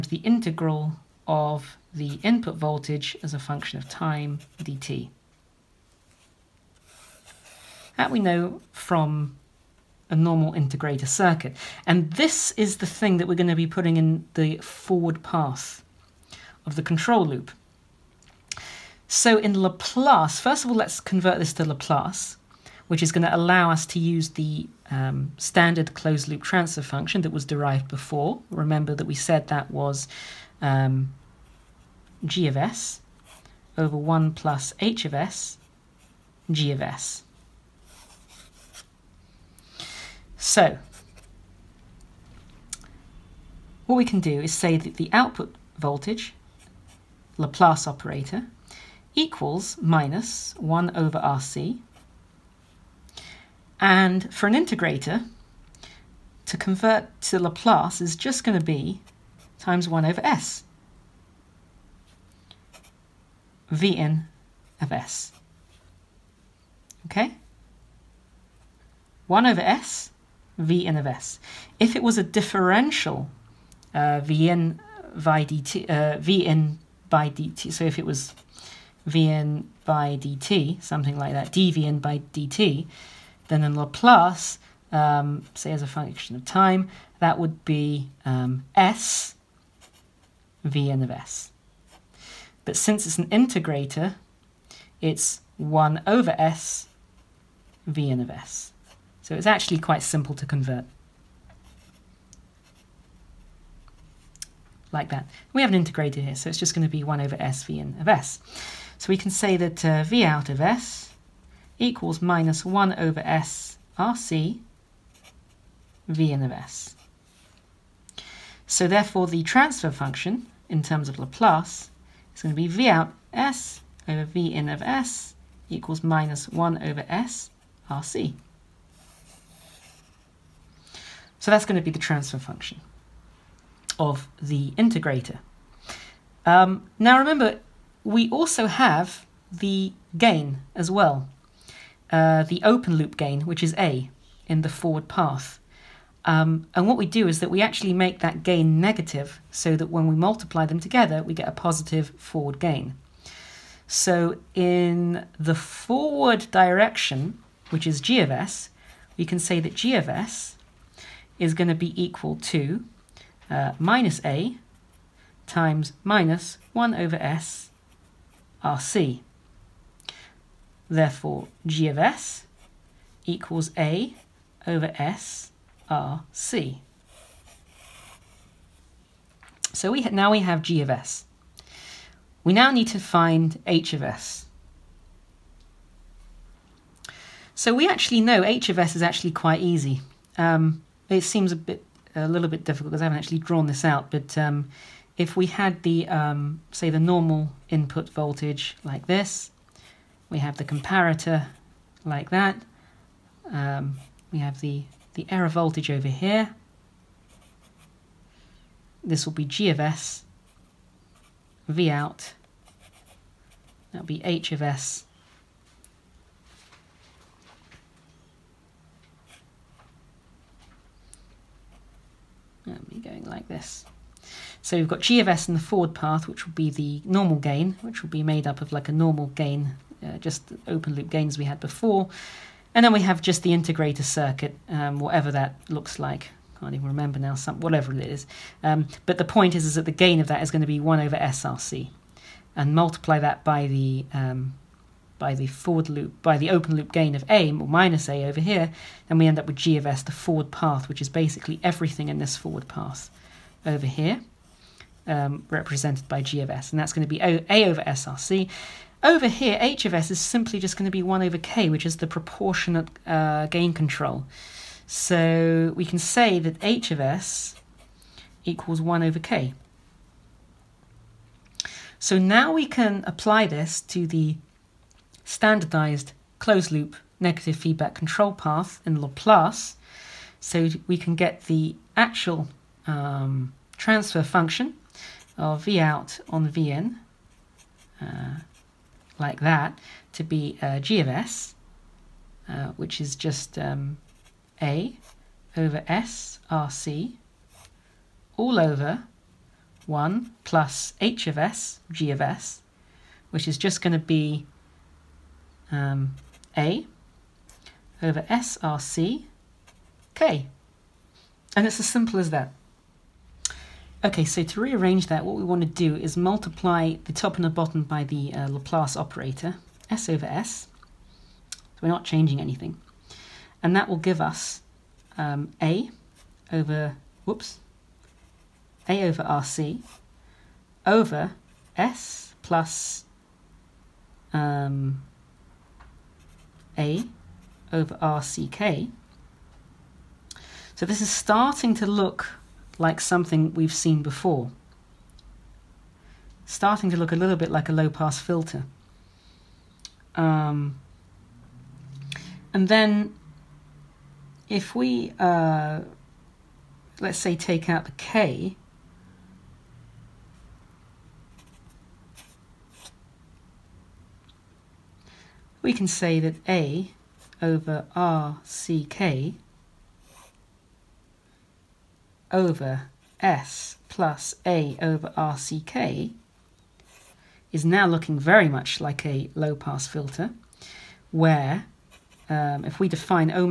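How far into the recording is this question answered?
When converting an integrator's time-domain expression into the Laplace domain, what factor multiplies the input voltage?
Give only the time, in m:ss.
0:59.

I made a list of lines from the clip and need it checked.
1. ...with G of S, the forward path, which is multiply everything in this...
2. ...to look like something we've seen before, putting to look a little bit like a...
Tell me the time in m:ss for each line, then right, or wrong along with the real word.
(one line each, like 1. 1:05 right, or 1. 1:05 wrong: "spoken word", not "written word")
1. 4:09 wrong: "basically", not "multiply"
2. 5:41 wrong: "starting", not "putting".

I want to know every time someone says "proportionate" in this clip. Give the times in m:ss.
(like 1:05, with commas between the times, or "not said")
4:22.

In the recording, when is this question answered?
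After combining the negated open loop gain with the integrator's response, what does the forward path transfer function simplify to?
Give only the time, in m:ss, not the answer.
2:51.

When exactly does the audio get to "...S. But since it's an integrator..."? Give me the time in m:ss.
1:31.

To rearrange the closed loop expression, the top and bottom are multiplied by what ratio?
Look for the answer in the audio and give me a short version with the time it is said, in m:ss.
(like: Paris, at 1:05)
s over s, at 5:19.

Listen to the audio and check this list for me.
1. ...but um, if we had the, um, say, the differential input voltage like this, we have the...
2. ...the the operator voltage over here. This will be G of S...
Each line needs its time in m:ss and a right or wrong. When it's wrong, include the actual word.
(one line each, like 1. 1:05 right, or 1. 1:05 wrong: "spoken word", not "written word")
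1. 3:14 wrong: "normal", not "differential"
2. 3:24 wrong: "error", not "operator".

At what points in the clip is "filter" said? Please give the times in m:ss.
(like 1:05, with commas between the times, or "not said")
5:48, 6:19.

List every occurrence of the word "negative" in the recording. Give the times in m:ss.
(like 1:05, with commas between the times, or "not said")
2:28, 4:37.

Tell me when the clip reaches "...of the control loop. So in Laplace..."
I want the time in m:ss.
0:16.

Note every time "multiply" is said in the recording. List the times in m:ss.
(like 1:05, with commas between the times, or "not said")
2:30, 4:02, 5:16.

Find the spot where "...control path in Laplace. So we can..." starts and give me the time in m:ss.
4:37.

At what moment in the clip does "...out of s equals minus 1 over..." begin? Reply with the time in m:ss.
1:50.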